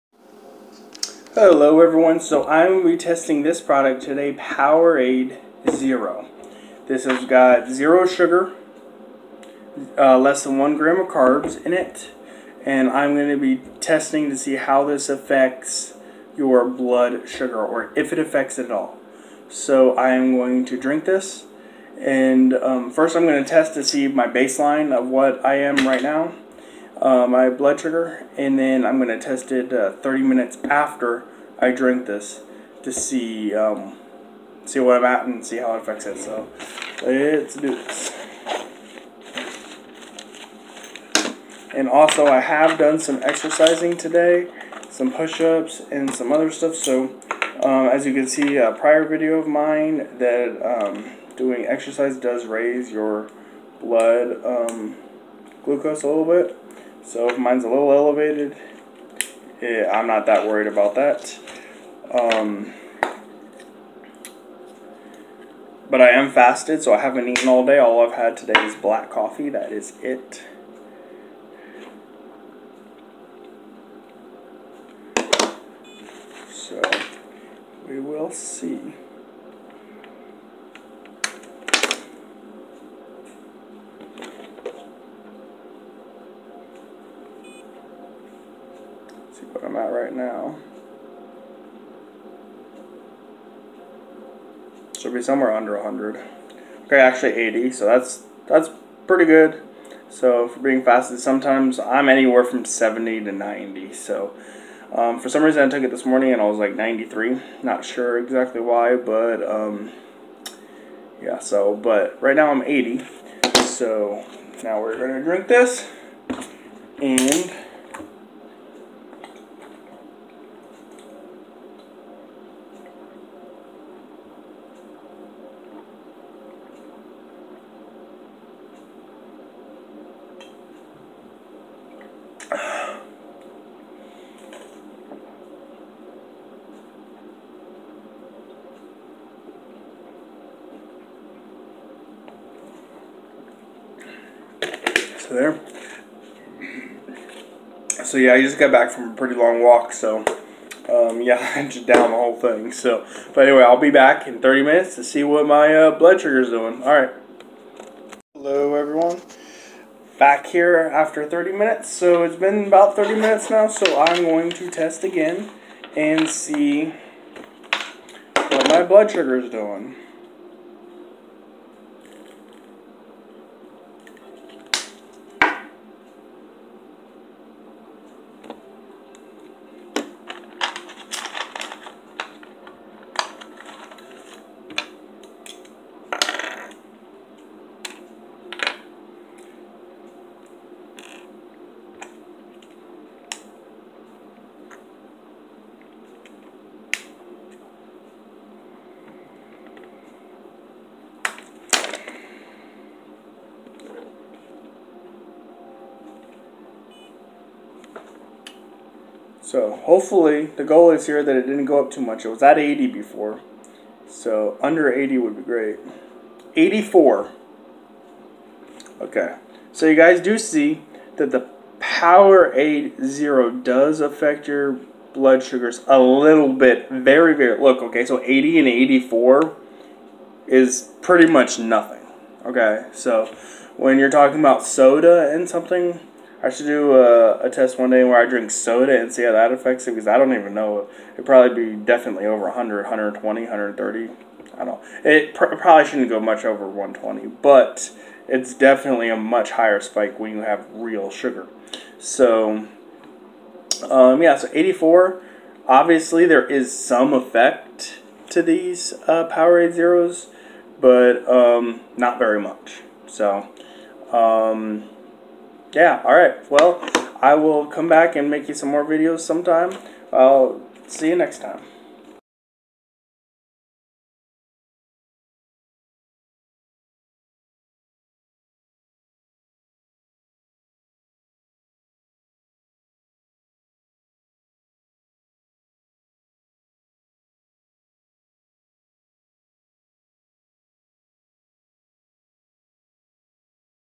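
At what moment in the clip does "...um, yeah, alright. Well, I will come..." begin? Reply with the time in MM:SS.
04:24.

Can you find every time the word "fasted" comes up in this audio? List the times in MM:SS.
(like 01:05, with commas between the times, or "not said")
01:06, 01:40.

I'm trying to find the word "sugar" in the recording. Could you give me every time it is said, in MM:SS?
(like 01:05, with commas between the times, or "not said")
00:08, 00:17, 00:27, 02:49, 03:45, 04:11.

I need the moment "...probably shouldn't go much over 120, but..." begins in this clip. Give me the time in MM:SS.
04:05.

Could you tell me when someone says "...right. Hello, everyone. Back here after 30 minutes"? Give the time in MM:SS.
02:36.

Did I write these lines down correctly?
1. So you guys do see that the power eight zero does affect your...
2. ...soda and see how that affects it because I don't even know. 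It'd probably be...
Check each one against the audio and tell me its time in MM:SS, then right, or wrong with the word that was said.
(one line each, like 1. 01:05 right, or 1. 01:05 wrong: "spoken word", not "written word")
1. 03:39 right
2. 03:58 right.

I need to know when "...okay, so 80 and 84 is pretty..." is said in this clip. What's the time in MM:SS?
03:47.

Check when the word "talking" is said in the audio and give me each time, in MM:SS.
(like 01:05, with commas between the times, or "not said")
03:54.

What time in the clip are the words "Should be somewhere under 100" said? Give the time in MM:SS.
01:34.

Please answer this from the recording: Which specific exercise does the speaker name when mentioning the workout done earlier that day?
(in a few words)
push-ups.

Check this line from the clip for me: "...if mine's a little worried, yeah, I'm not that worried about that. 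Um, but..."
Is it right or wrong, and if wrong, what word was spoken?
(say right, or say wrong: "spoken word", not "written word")
wrong: "elevated", not "worried".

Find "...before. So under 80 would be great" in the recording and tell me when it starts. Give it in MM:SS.
03:32.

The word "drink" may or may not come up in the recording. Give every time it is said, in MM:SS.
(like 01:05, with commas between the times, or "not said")
00:20, 00:31, 01:55, 03:58.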